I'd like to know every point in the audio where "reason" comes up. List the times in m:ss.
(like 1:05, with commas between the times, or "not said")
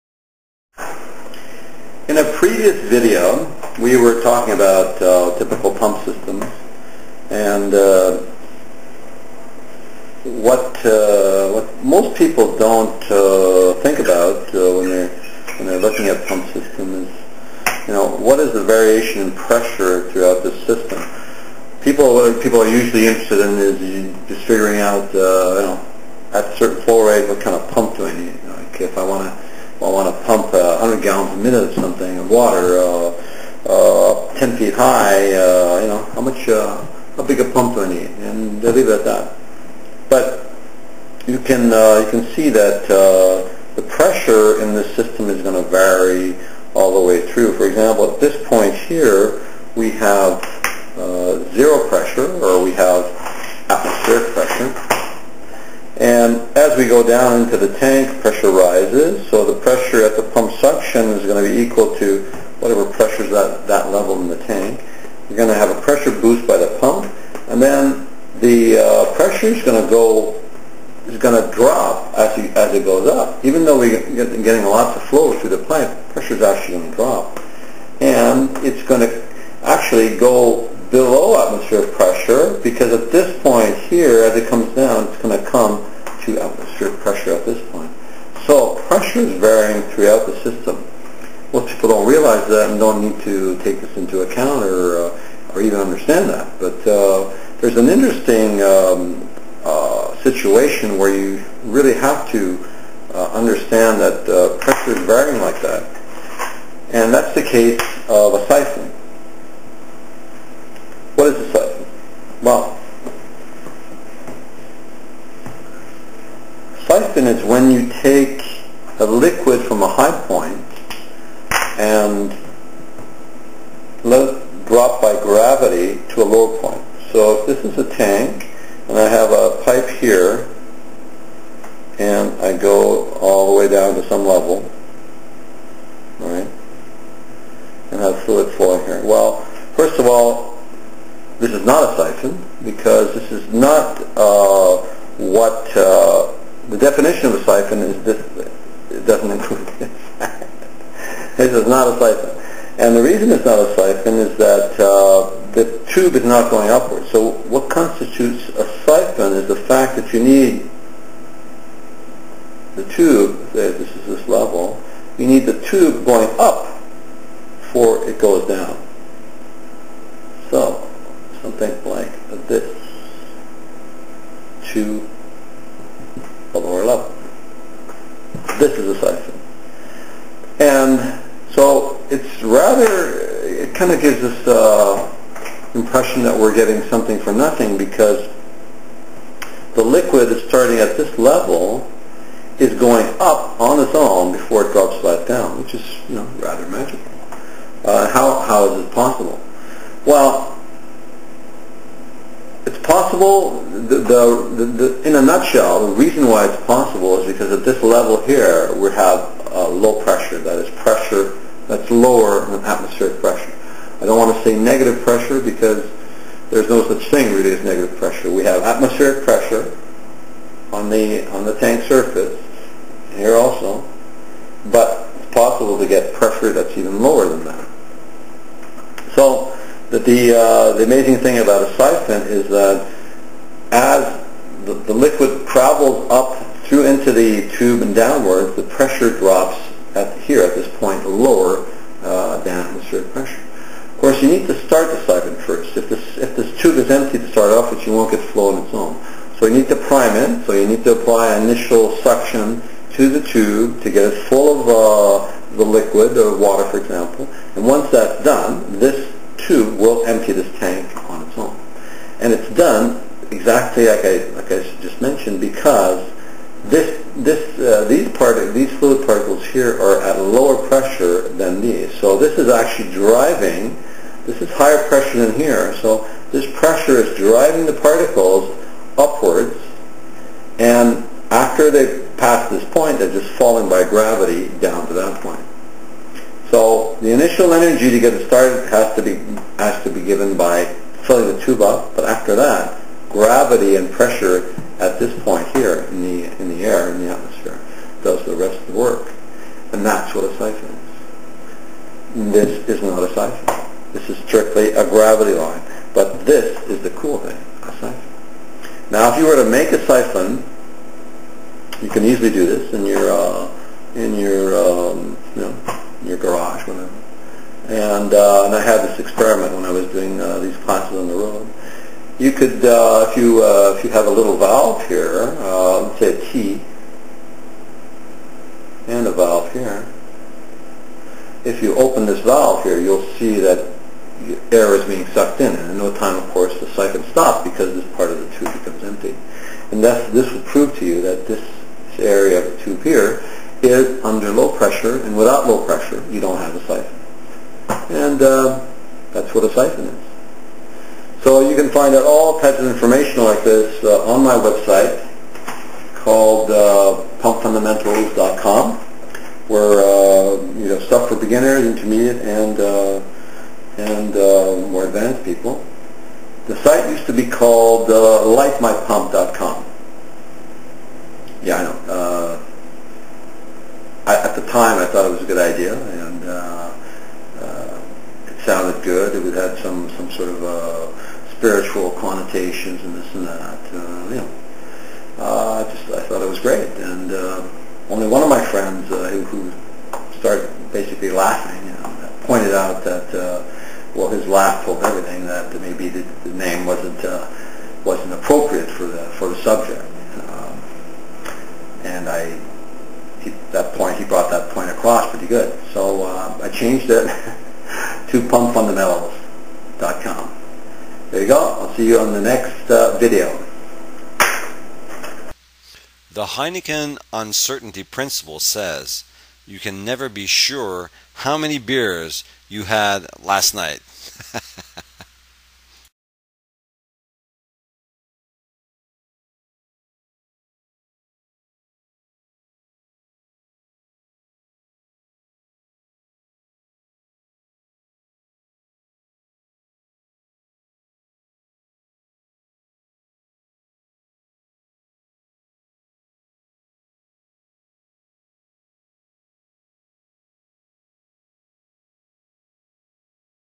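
2:33, 3:25.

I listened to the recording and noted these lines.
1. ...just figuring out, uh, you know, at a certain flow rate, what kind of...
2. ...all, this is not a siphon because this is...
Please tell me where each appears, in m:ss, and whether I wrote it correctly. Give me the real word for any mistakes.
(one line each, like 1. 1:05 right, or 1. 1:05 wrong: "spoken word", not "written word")
1. 0:24 right
2. 2:20 right.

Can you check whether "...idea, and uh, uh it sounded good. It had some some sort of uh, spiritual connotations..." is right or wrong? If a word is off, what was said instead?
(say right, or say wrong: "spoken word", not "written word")
right.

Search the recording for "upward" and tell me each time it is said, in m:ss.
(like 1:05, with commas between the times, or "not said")
2:36, 4:38.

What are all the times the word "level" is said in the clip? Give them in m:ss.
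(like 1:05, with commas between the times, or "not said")
1:03, 2:14, 2:44, 3:11, 3:27.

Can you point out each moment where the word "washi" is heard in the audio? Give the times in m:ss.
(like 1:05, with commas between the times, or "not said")
not said.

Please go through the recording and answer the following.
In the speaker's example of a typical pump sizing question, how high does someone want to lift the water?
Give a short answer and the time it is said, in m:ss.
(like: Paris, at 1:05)
10 feet, at 0:34.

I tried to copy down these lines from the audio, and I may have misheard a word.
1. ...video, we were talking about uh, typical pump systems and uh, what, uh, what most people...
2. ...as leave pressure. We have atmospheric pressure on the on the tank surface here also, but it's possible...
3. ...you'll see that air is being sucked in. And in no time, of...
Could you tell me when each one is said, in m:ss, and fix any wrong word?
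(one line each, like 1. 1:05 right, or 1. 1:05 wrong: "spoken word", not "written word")
1. 0:02 right
2. 3:37 wrong: "negative", not "leave"
3. 5:32 right.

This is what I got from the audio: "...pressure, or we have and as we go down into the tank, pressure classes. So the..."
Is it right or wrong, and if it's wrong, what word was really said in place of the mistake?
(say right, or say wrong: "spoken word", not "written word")
wrong: "rises", not "classes".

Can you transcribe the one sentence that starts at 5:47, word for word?
And uh, that's what a siphon is.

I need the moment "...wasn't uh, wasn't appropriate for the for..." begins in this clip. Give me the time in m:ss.
6:36.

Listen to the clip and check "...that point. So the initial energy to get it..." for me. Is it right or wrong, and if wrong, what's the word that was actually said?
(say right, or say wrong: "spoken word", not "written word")
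right.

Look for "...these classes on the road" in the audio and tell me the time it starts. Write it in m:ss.
5:20.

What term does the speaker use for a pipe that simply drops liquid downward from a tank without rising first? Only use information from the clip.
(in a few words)
Gravity line.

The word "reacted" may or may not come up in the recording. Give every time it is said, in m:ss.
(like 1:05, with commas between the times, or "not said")
not said.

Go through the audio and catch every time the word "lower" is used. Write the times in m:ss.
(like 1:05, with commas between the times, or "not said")
2:06, 3:31, 3:47, 4:01, 4:30.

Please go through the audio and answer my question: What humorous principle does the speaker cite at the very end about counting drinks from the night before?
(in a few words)
Heineken Uncertainty Principle.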